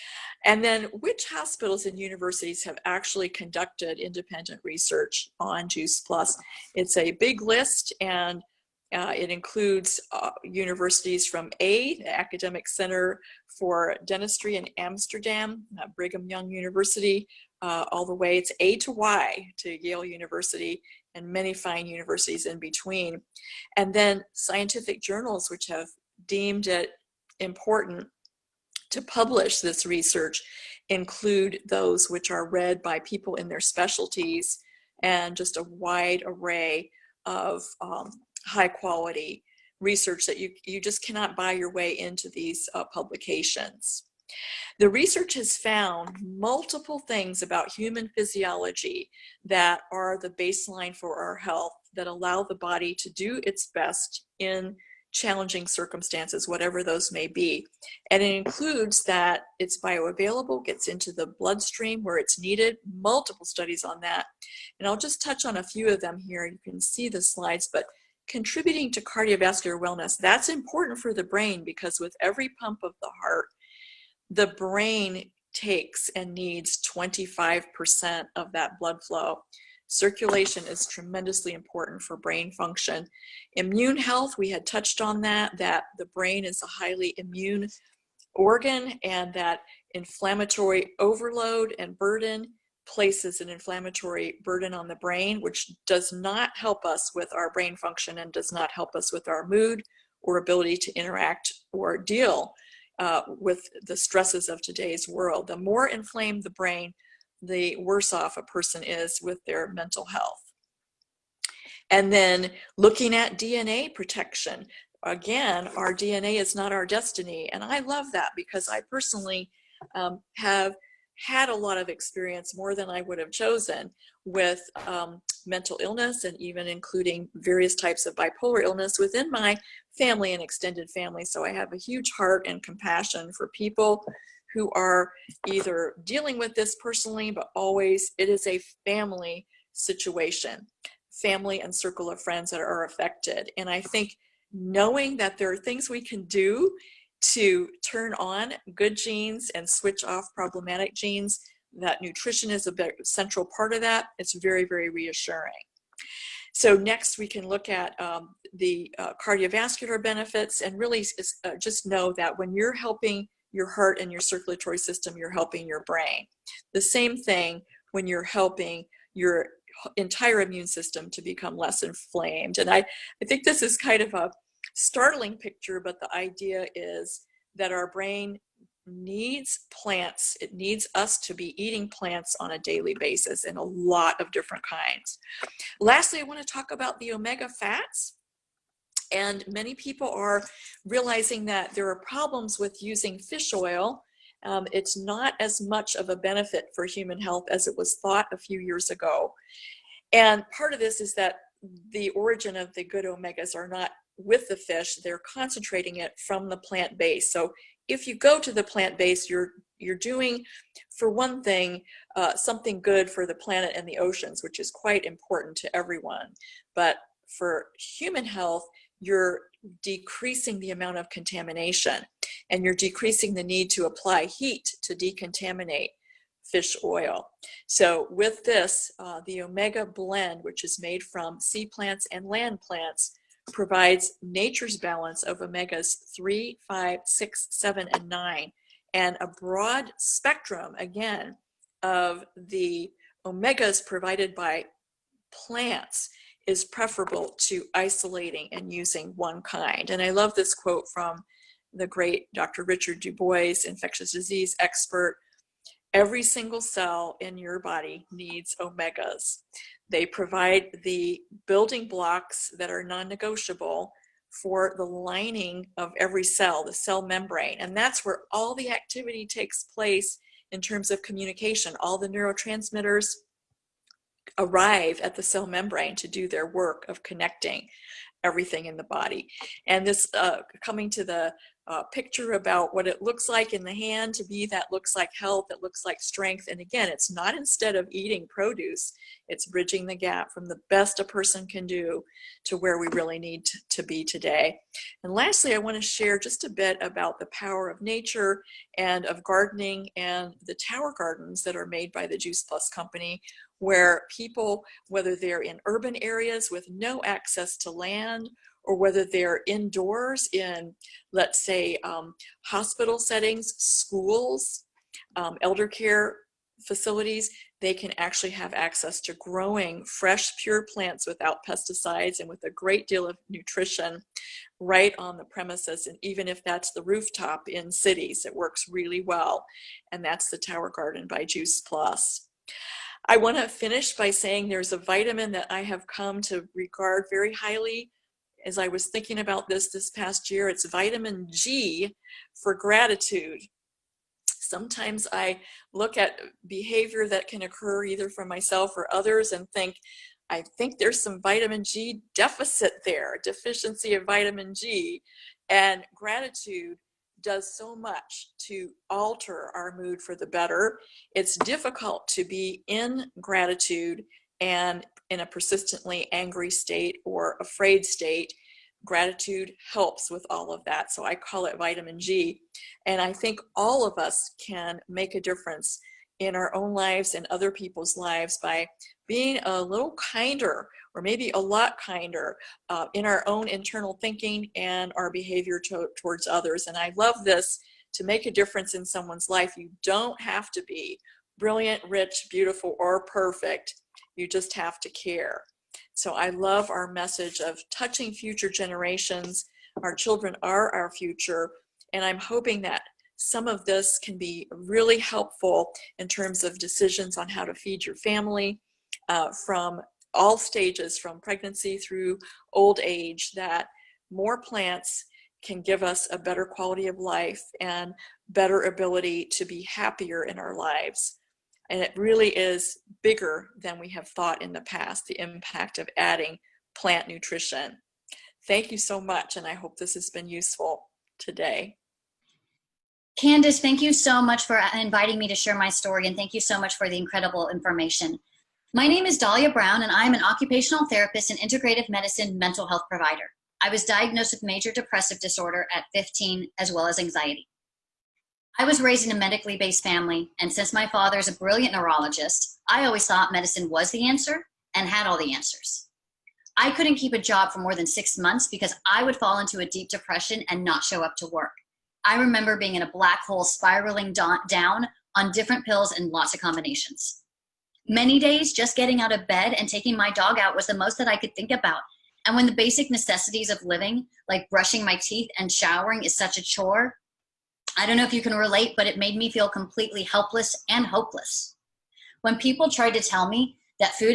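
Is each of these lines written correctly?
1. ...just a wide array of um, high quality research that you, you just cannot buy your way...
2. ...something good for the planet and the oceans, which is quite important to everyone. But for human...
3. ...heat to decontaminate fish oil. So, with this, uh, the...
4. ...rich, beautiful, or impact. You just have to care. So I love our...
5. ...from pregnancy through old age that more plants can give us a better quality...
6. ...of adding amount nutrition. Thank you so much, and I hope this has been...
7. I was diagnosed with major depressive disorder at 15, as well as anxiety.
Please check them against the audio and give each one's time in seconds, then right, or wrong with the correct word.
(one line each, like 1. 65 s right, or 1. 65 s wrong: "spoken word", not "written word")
1. 35 s right
2. 212 s right
3. 224 s right
4. 391 s wrong: "perfect", not "impact"
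5. 410 s right
6. 425 s wrong: "plant", not "amount"
7. 443 s right.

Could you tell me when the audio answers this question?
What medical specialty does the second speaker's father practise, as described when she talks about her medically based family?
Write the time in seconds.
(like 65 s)
451 s.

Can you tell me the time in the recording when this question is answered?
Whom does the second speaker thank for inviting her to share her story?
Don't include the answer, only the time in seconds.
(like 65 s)
433 s.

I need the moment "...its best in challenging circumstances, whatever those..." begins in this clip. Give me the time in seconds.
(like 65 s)
53 s.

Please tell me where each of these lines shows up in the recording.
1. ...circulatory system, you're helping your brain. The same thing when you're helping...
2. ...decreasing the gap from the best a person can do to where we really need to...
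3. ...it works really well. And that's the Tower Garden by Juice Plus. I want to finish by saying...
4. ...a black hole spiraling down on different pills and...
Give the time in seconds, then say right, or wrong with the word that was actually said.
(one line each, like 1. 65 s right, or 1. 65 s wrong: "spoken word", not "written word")
1. 164 s right
2. 289 s wrong: "bridging", not "decreasing"
3. 328 s right
4. 462 s right.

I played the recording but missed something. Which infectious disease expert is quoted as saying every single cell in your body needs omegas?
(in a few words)
Richard Du Bois.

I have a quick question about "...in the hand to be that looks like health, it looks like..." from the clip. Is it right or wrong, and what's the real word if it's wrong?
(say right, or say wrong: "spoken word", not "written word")
right.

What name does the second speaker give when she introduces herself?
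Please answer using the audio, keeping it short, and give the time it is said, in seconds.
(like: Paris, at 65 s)
Dahlia Brown, at 439 s.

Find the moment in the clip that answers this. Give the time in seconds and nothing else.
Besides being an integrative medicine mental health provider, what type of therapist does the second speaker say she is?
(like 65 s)
440 s.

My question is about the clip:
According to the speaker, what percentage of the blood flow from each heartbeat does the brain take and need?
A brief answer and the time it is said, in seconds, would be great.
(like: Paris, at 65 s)
25%, at 76 s.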